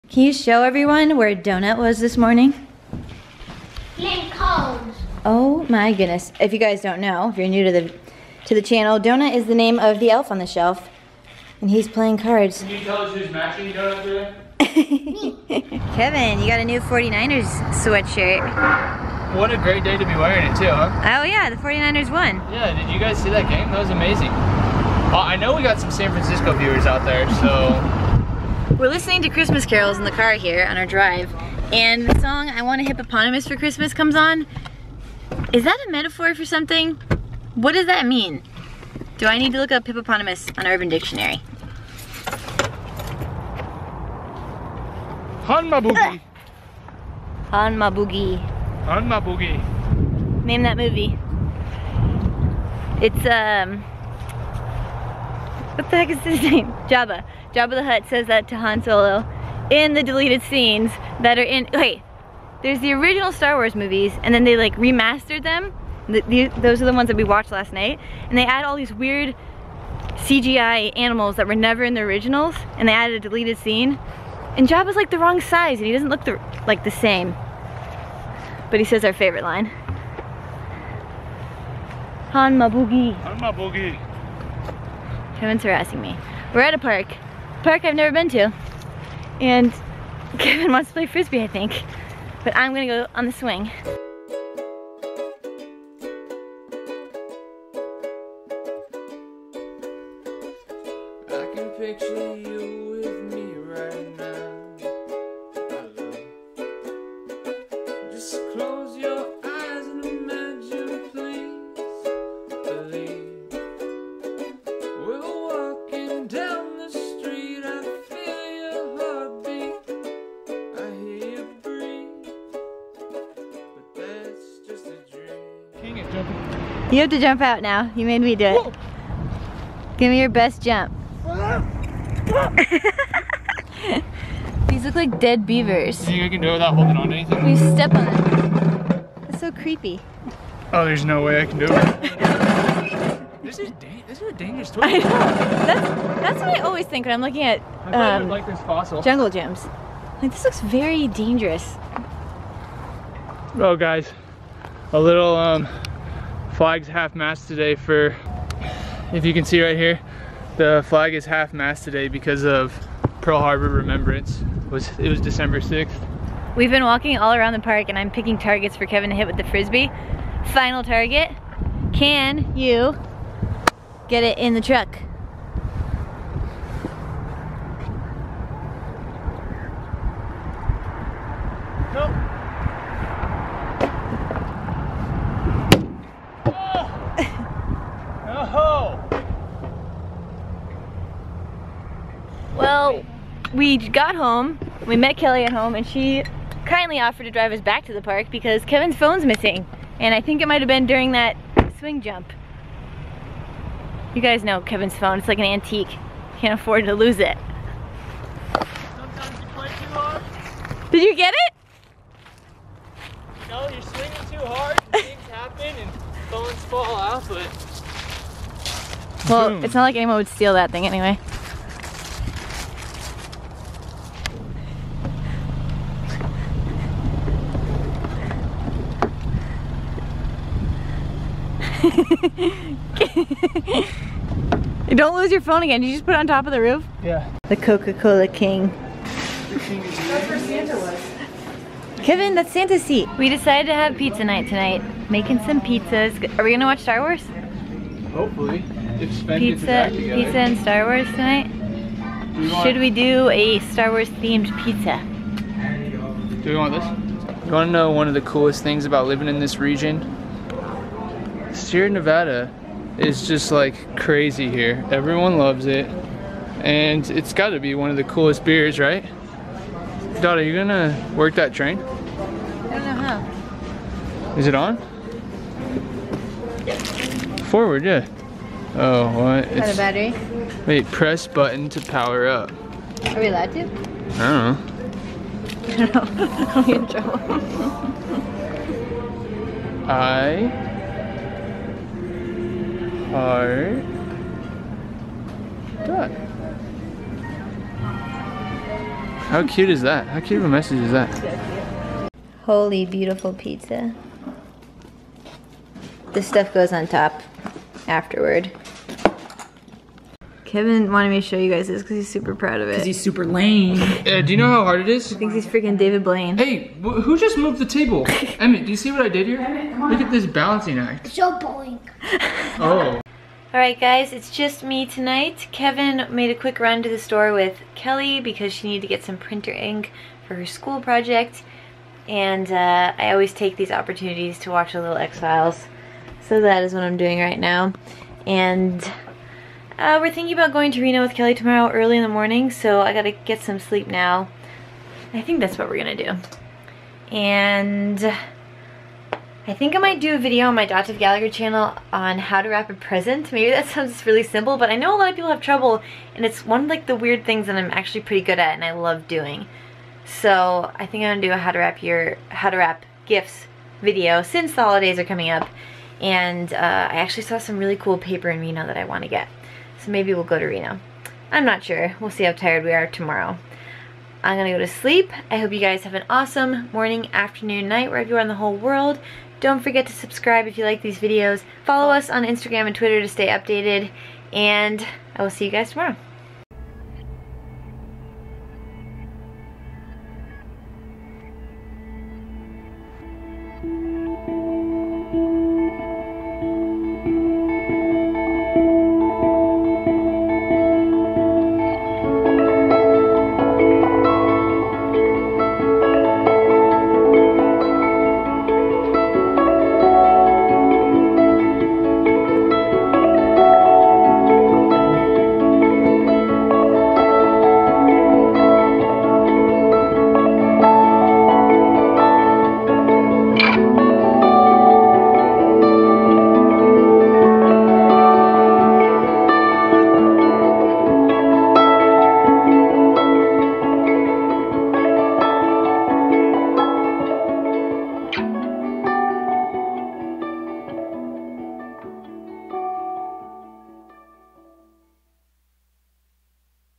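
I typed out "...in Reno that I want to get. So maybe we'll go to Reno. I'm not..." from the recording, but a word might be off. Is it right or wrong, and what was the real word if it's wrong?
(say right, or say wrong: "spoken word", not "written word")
right.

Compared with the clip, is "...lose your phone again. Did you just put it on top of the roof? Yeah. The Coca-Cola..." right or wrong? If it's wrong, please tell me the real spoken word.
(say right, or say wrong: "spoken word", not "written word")
right.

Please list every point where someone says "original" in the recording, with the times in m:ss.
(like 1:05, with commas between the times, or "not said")
1:02, 1:12.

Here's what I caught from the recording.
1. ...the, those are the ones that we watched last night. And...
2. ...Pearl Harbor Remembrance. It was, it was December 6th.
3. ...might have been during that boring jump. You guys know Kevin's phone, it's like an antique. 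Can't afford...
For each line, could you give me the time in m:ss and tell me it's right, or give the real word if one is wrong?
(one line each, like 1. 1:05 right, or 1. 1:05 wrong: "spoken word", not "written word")
1. 1:06 right
2. 2:43 right
3. 3:20 wrong: "swing", not "boring".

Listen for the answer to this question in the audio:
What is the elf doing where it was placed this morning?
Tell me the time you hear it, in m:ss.
0:11.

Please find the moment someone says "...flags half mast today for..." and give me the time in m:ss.
2:36.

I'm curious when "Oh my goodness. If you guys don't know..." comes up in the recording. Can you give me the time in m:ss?
0:05.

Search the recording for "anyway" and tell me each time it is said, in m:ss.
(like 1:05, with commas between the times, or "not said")
3:40.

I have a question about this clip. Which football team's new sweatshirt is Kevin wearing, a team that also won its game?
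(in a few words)
49ers.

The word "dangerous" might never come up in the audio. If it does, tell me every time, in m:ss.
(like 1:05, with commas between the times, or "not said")
2:24, 2:31.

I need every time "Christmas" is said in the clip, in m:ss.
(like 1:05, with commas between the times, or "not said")
0:29, 0:33.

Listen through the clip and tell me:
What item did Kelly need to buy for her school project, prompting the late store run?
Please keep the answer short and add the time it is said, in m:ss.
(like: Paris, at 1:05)
Printer ink, at 5:29.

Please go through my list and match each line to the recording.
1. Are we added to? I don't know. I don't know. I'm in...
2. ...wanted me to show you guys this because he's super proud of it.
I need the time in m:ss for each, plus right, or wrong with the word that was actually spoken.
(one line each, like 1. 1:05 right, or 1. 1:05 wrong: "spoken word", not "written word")
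1. 4:43 wrong: "allowed", not "added"
2. 5:10 right.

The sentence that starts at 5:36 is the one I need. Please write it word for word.
So that is what I'm doing right now.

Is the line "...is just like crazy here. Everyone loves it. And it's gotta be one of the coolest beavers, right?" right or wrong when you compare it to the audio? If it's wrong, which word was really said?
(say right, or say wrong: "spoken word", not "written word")
wrong: "beers", not "beavers".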